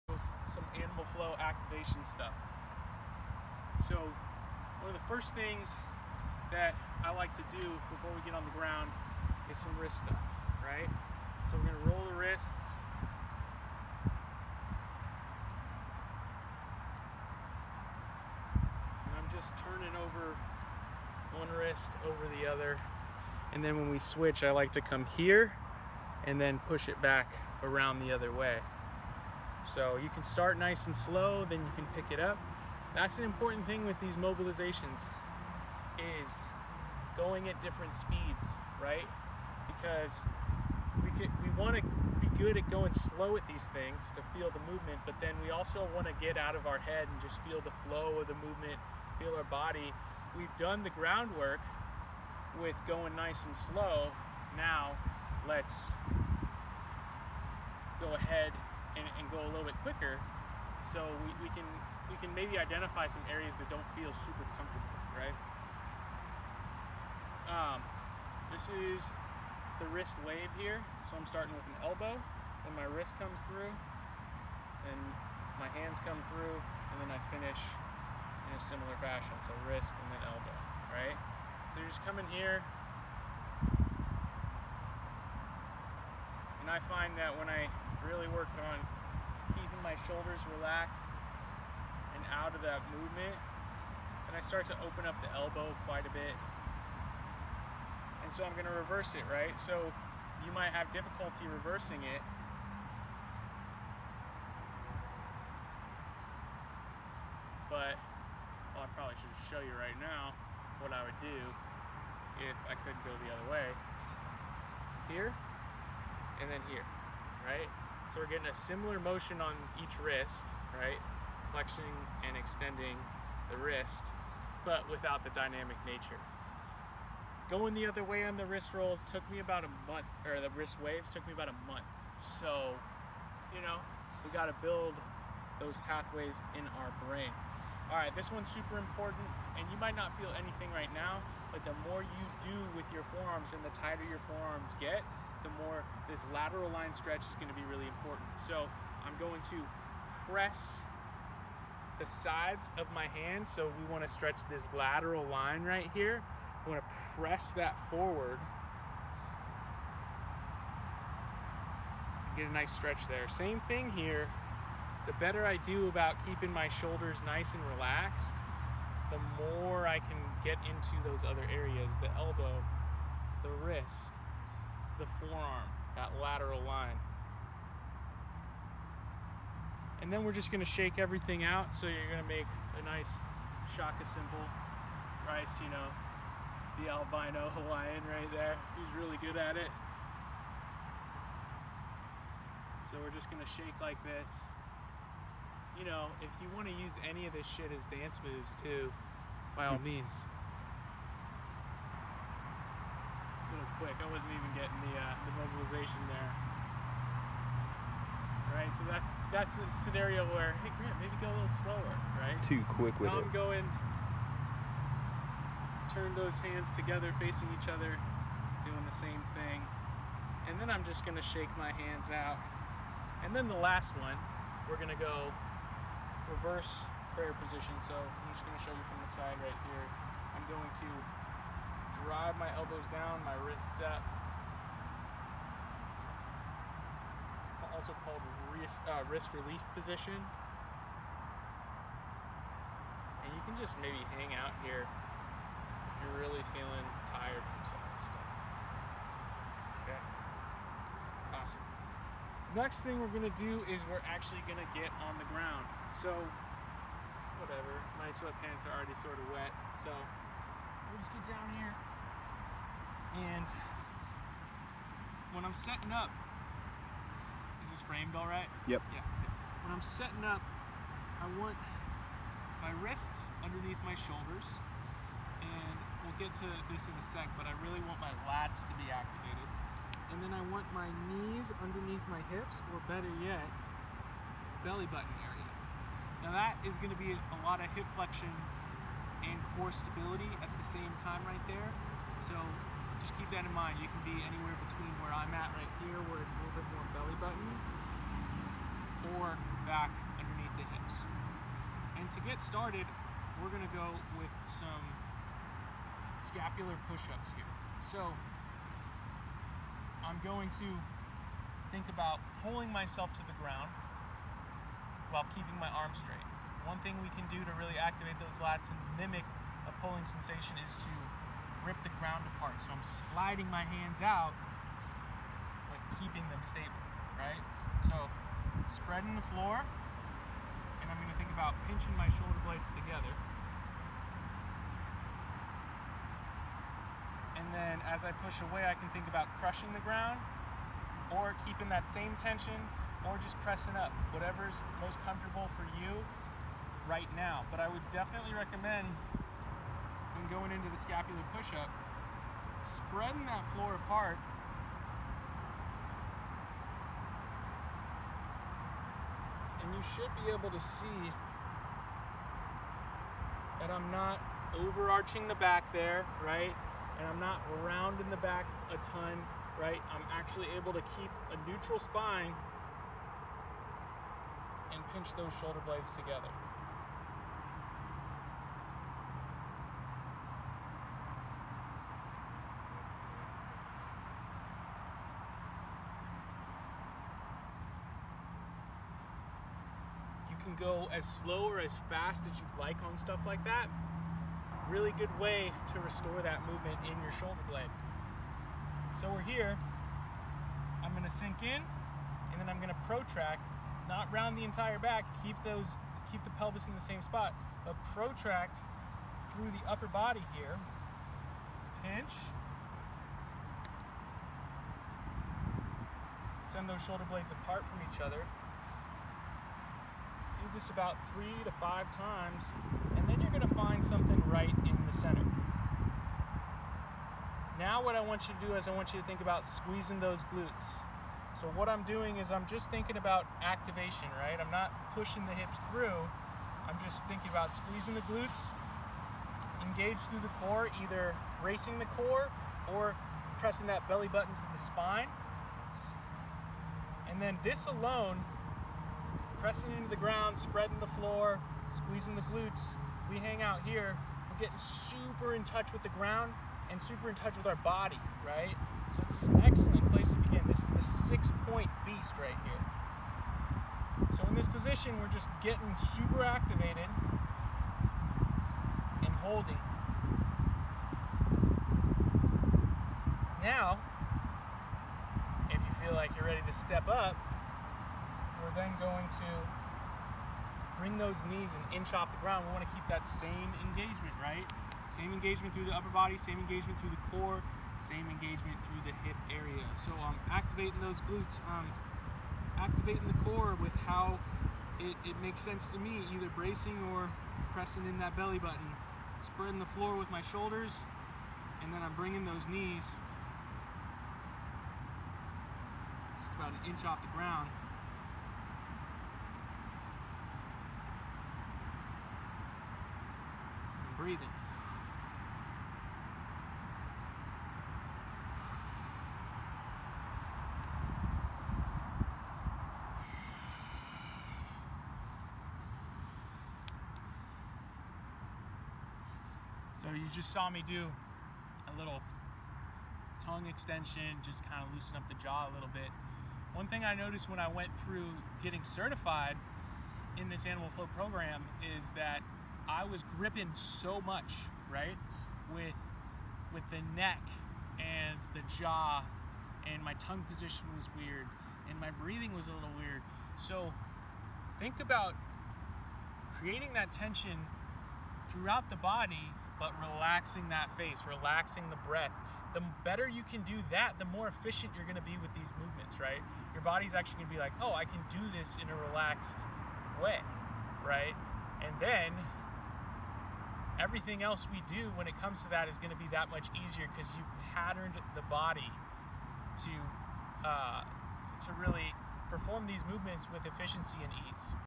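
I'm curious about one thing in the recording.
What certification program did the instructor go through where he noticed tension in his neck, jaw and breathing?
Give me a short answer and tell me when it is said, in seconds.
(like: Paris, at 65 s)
Animal Flow, at 540 s.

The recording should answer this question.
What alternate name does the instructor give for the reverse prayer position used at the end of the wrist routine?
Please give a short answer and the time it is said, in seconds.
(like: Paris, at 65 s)
wrist relief position, at 239 s.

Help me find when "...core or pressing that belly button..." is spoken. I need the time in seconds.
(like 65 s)
441 s.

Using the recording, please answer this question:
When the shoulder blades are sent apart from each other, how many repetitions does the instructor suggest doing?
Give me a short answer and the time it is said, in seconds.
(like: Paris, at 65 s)
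3 to 5, at 421 s.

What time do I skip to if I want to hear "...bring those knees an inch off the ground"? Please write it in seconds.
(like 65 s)
480 s.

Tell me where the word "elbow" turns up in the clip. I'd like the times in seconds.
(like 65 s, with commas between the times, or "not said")
71 s, 80 s, 95 s, 172 s, 232 s.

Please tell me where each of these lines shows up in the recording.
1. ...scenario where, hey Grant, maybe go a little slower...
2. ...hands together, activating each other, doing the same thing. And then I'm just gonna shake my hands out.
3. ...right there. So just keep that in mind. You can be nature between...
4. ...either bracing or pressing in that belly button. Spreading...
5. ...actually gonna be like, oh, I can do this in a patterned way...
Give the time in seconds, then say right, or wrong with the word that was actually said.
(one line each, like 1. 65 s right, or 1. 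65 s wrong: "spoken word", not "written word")
1. 209 s right
2. 216 s wrong: "facing", not "activating"
3. 291 s wrong: "anywhere", not "nature"
4. 496 s right
5. 566 s wrong: "relaxed", not "patterned".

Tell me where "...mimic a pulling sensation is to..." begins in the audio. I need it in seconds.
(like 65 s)
319 s.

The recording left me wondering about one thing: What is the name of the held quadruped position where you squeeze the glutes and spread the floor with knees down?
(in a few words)
six point beast.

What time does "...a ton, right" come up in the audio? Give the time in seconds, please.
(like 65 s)
368 s.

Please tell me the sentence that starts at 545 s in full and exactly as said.
With with the neck and the jaw and my tongue position was weird and my breathing was a little weird.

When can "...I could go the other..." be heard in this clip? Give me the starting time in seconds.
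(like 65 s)
112 s.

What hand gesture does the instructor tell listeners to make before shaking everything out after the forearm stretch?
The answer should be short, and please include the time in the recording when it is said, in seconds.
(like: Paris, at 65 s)
shaka, at 183 s.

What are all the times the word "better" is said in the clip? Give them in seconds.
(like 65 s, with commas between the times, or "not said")
165 s, 282 s, 562 s.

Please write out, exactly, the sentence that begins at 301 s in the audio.
And to get started, we're gonna go with some scapular push-ups here.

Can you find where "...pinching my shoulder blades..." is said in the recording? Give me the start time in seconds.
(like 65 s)
331 s.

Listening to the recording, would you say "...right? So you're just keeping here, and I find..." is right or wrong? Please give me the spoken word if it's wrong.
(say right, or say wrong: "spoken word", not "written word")
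wrong: "coming", not "keeping".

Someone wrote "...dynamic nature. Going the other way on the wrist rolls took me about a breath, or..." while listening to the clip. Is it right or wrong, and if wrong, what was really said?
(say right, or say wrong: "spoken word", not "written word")
wrong: "month", not "breath".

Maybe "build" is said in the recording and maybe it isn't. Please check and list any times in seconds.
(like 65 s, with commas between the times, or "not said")
134 s.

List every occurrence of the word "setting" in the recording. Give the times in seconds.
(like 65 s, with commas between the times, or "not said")
265 s, 269 s.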